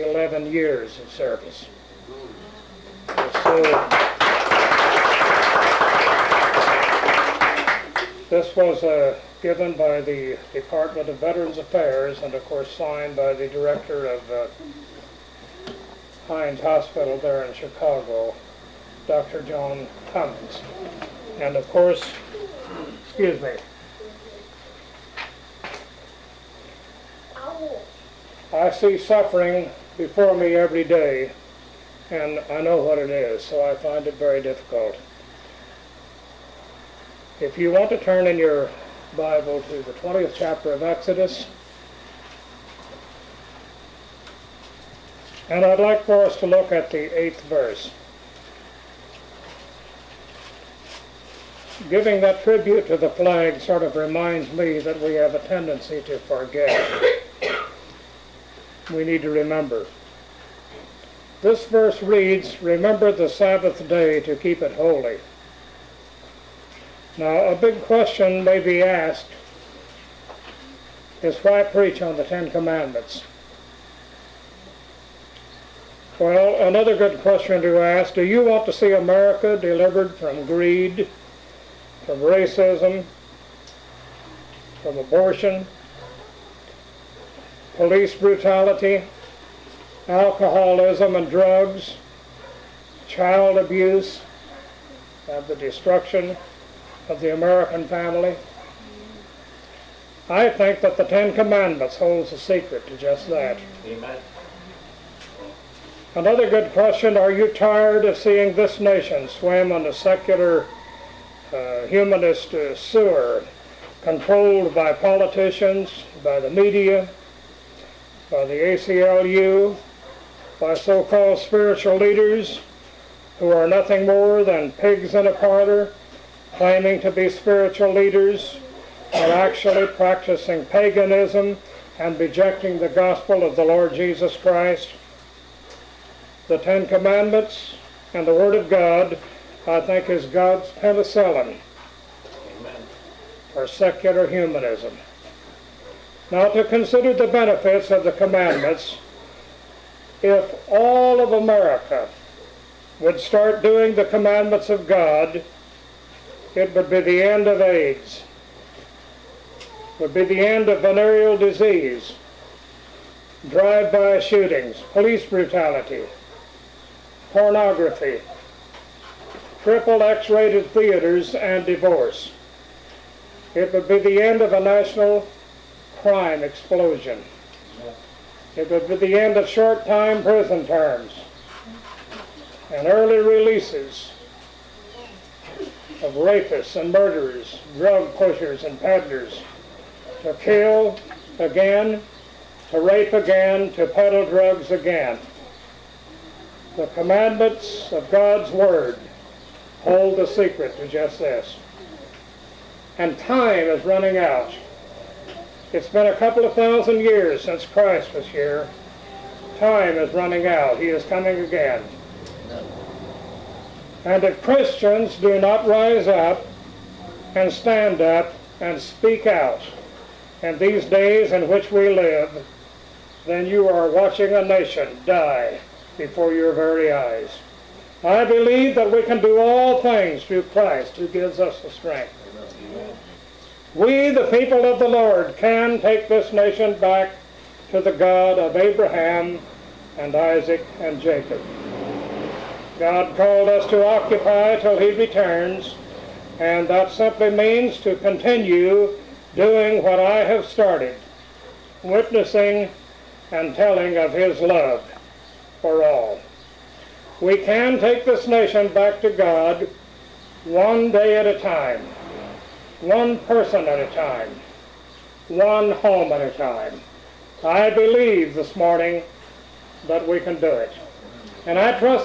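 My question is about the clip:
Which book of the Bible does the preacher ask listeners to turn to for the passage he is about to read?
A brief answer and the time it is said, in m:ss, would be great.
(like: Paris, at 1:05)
Exodus, at 0:40.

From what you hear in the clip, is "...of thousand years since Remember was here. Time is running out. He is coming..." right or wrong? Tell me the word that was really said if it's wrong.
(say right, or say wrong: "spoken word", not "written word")
wrong: "Christ", not "Remember".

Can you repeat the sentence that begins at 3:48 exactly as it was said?
I believe that we can do all things through Christ who gives us the strength.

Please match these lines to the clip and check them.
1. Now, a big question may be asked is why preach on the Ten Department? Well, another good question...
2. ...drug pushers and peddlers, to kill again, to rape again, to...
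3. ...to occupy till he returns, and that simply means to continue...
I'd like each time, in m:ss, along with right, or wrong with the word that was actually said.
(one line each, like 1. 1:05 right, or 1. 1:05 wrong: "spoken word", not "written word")
1. 1:07 wrong: "Commandments", not "Department"
2. 3:07 right
3. 4:03 right.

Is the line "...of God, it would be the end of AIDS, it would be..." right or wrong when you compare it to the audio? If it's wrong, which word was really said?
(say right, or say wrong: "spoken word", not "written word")
right.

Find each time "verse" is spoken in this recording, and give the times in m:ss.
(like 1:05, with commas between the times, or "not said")
0:47, 1:01.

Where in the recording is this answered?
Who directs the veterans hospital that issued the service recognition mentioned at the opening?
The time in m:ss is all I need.
0:19.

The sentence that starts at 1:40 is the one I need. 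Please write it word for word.
I think that the Ten Commandments holds the secret to just that.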